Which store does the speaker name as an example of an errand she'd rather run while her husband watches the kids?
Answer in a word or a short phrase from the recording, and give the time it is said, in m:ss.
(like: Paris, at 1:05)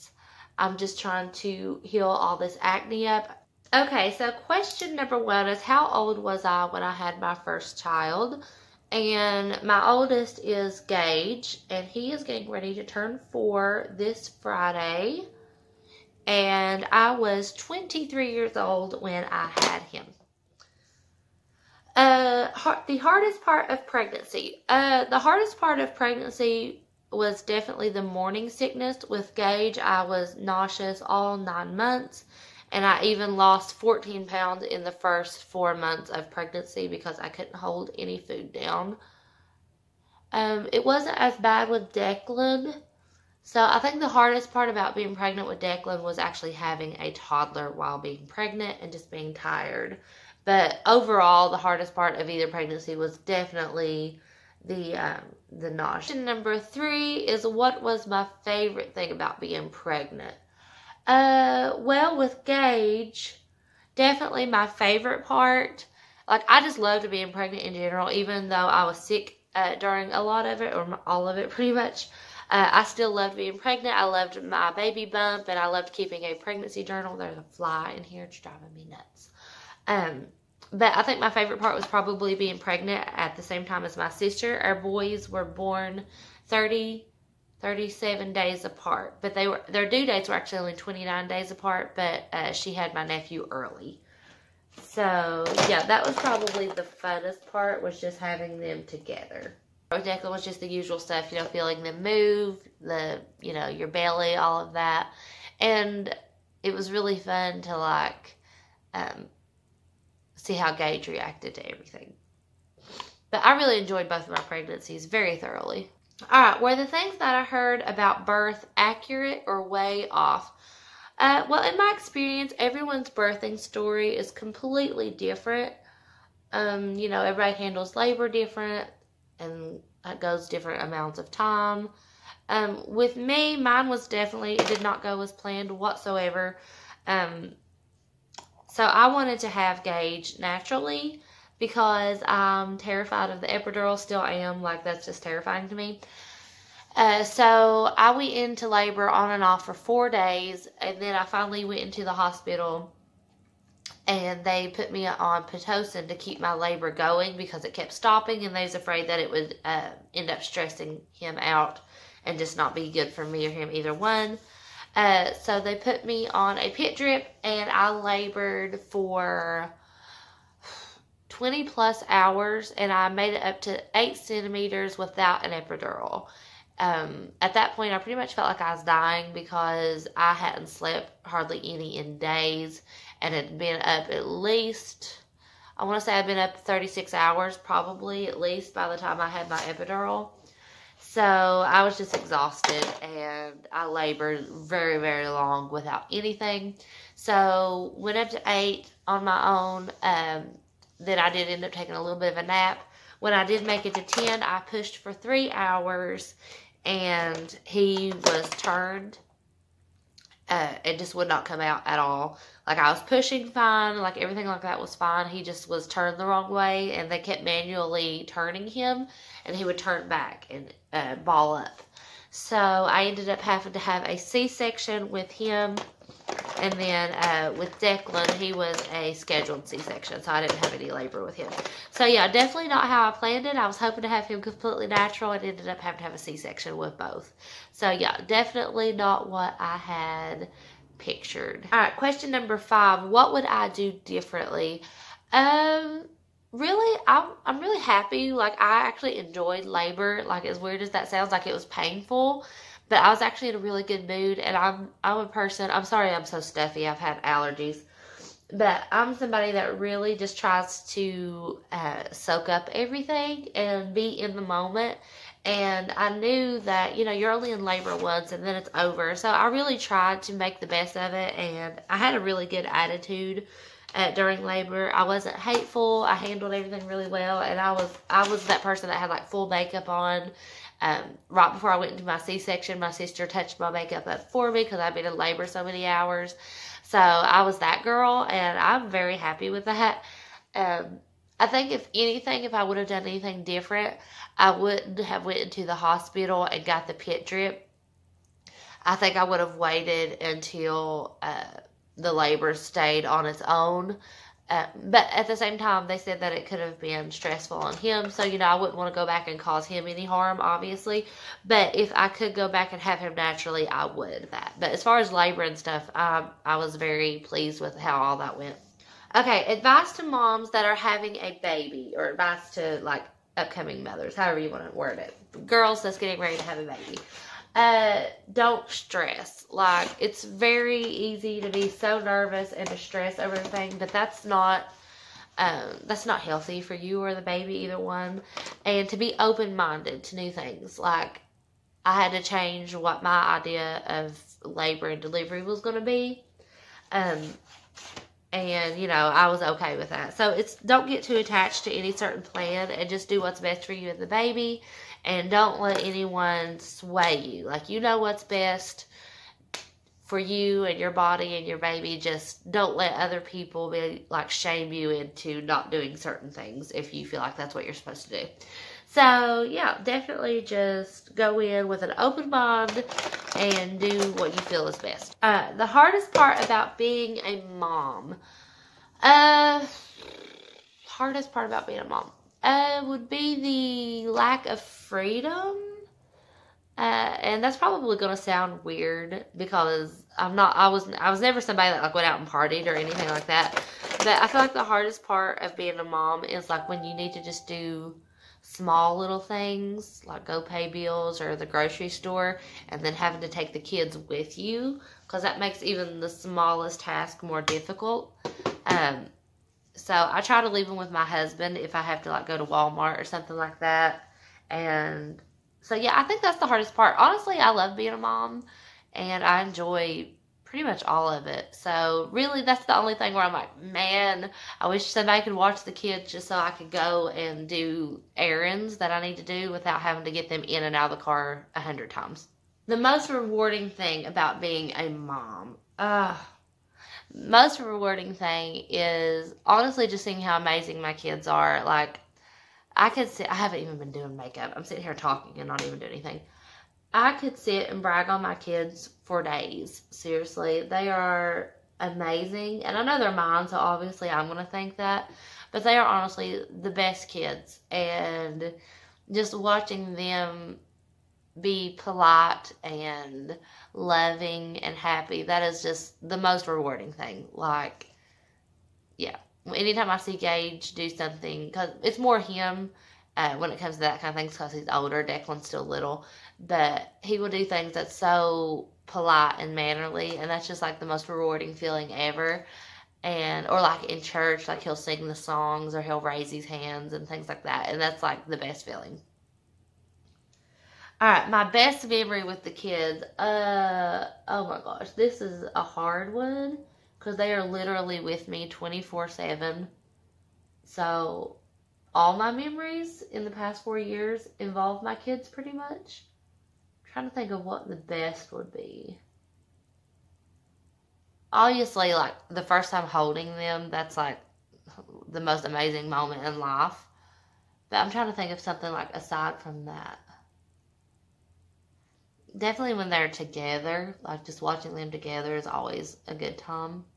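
Walmart, at 6:52.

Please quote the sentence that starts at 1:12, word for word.
Uh, I still loved being pregnant.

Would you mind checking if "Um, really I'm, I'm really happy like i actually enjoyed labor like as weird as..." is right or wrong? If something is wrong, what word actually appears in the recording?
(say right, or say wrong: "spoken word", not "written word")
right.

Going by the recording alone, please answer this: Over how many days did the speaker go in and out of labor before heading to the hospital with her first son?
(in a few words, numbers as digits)
4.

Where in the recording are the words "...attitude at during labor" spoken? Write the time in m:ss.
4:32.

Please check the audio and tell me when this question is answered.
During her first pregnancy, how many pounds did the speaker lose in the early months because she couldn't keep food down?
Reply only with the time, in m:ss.
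0:33.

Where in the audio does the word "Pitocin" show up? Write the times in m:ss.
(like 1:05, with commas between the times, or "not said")
2:35.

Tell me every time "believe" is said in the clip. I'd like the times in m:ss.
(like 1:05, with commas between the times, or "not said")
not said.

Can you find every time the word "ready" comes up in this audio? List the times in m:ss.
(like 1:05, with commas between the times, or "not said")
0:12, 5:26.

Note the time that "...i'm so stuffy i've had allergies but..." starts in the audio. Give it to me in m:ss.
4:16.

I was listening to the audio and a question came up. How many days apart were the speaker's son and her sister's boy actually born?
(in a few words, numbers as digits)
37.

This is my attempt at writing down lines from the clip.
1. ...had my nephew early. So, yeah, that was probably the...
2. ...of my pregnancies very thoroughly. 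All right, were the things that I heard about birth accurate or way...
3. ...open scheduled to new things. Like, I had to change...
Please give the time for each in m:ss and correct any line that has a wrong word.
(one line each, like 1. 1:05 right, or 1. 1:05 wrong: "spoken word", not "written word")
1. 1:32 right
2. 1:54 right
3. 5:39 wrong: "minded", not "scheduled".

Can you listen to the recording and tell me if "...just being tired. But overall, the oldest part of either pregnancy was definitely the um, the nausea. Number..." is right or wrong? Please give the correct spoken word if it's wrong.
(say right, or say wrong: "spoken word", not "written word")
wrong: "hardest", not "oldest".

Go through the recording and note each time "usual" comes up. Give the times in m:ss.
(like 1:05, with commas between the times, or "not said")
1:40.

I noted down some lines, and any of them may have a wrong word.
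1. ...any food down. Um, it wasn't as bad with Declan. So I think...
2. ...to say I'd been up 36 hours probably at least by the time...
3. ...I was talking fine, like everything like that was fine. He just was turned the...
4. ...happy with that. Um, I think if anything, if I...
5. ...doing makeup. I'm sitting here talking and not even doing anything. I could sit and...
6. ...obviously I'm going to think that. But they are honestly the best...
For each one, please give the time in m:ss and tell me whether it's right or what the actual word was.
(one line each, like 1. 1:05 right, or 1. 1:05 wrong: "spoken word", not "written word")
1. 0:37 right
2. 3:05 right
3. 3:32 wrong: "pushing", not "talking"
4. 4:49 right
5. 7:23 right
6. 7:33 right.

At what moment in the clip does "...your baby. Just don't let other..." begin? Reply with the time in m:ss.
6:01.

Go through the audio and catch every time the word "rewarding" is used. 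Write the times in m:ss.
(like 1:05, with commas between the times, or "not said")
7:13, 7:17, 7:46, 8:01.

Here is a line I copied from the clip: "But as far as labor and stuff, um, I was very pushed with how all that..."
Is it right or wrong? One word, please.
wrong.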